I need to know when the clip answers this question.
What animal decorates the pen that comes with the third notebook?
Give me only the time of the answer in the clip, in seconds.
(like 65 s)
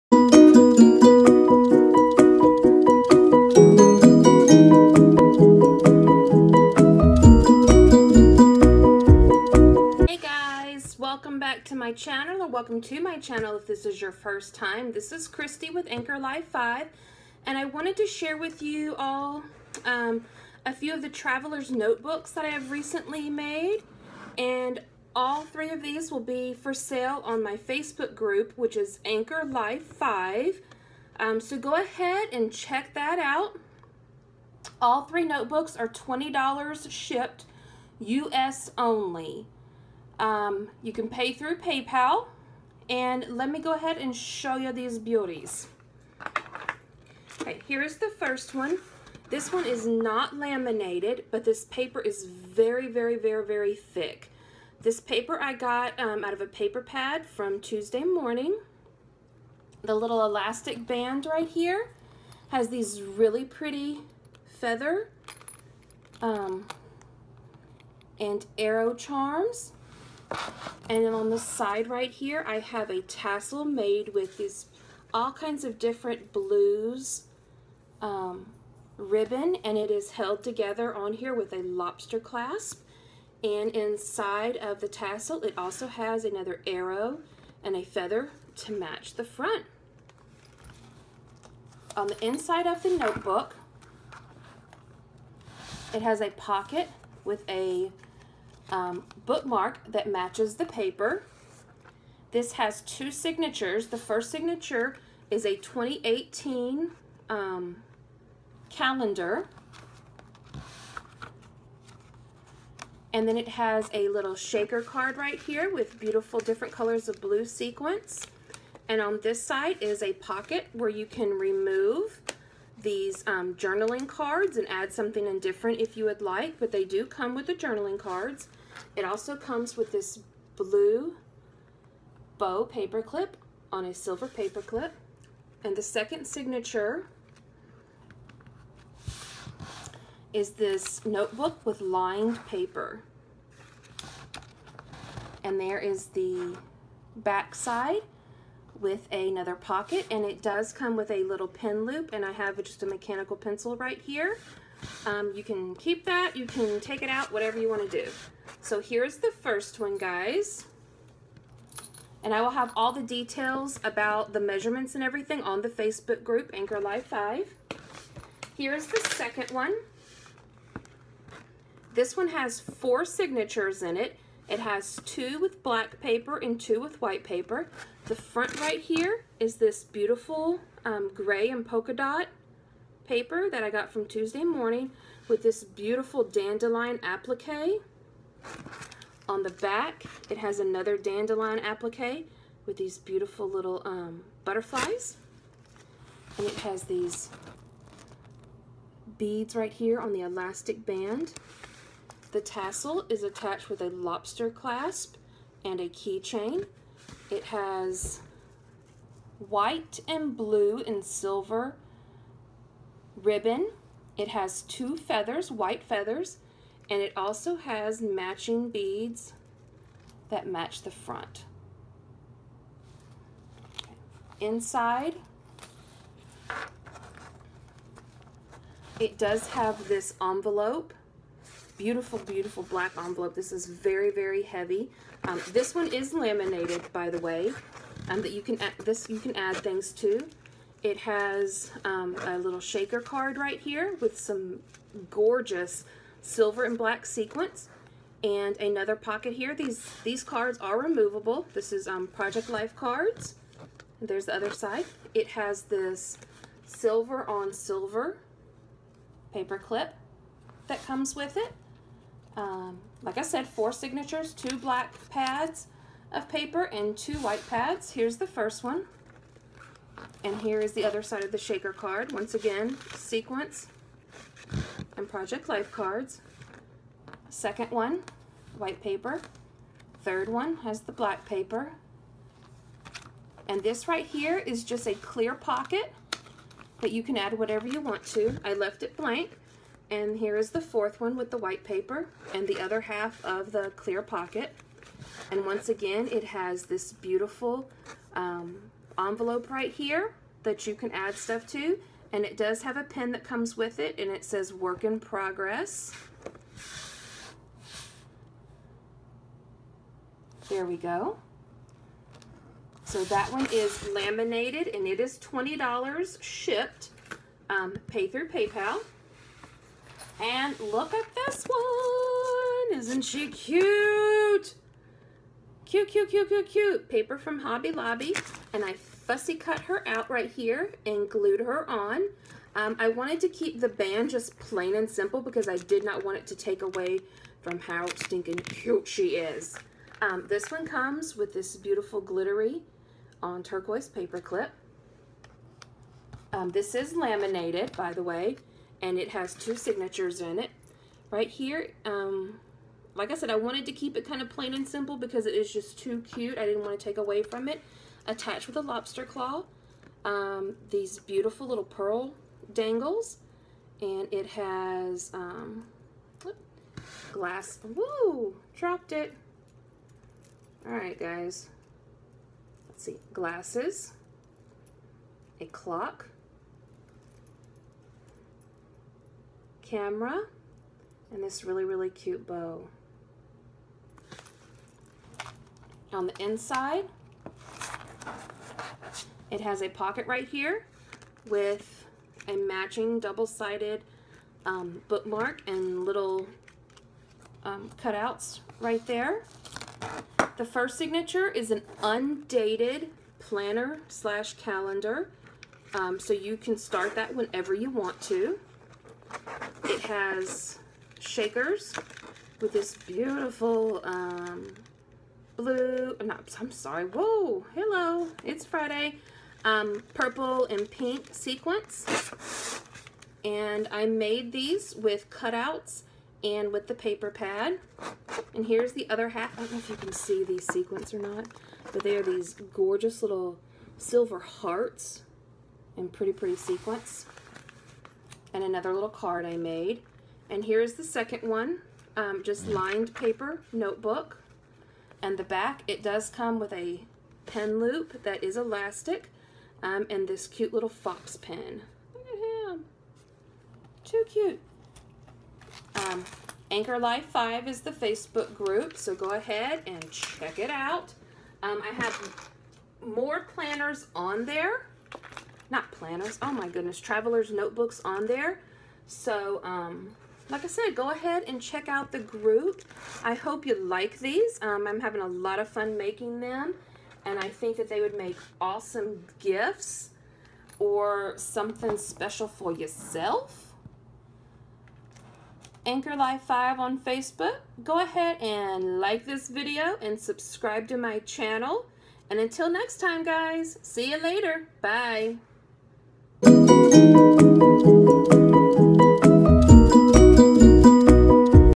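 450 s.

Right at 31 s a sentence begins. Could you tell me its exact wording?
Um, so go ahead and check that out.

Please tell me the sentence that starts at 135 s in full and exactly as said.
And the second signature is this notebook with lined paper.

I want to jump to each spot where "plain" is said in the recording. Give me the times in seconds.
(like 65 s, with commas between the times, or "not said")
334 s, 354 s.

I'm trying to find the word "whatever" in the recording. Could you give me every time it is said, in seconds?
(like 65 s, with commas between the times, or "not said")
157 s, 287 s.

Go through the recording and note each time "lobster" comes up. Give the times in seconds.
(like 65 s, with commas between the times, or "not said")
81 s, 203 s, 358 s.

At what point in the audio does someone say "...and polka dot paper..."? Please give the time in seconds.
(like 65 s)
181 s.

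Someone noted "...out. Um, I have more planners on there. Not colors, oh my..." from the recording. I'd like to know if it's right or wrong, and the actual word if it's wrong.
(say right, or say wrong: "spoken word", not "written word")
wrong: "planners", not "colors".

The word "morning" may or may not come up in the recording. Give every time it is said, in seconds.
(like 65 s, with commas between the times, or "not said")
58 s, 184 s.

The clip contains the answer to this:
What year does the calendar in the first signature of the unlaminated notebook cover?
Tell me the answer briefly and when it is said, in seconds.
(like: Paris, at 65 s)
2018, at 105 s.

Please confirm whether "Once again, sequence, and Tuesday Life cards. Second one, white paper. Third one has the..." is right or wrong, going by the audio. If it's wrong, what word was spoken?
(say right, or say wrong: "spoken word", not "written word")
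wrong: "Project", not "Tuesday".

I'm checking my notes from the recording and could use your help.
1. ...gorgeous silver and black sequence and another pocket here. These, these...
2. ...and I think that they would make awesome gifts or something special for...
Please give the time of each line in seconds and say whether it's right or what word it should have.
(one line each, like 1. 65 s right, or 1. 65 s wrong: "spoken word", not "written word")
1. 245 s right
2. 477 s right.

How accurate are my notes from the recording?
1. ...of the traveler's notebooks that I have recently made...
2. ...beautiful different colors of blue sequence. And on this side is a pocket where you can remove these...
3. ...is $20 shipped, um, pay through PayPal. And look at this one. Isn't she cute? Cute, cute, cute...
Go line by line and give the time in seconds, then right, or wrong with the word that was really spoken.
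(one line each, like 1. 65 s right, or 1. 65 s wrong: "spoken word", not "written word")
1. 20 s right
2. 115 s right
3. 314 s right.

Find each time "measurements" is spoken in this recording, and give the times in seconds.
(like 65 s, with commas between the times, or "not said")
164 s.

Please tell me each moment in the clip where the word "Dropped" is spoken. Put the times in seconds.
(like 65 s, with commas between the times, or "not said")
368 s.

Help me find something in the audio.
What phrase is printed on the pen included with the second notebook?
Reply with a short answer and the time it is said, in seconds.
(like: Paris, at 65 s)
Work in progress, at 304 s.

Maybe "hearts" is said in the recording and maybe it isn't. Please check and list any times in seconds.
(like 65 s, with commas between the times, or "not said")
434 s.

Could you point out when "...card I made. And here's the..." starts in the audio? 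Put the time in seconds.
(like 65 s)
438 s.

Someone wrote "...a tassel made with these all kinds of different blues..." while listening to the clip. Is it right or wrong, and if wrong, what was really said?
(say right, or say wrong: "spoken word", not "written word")
right.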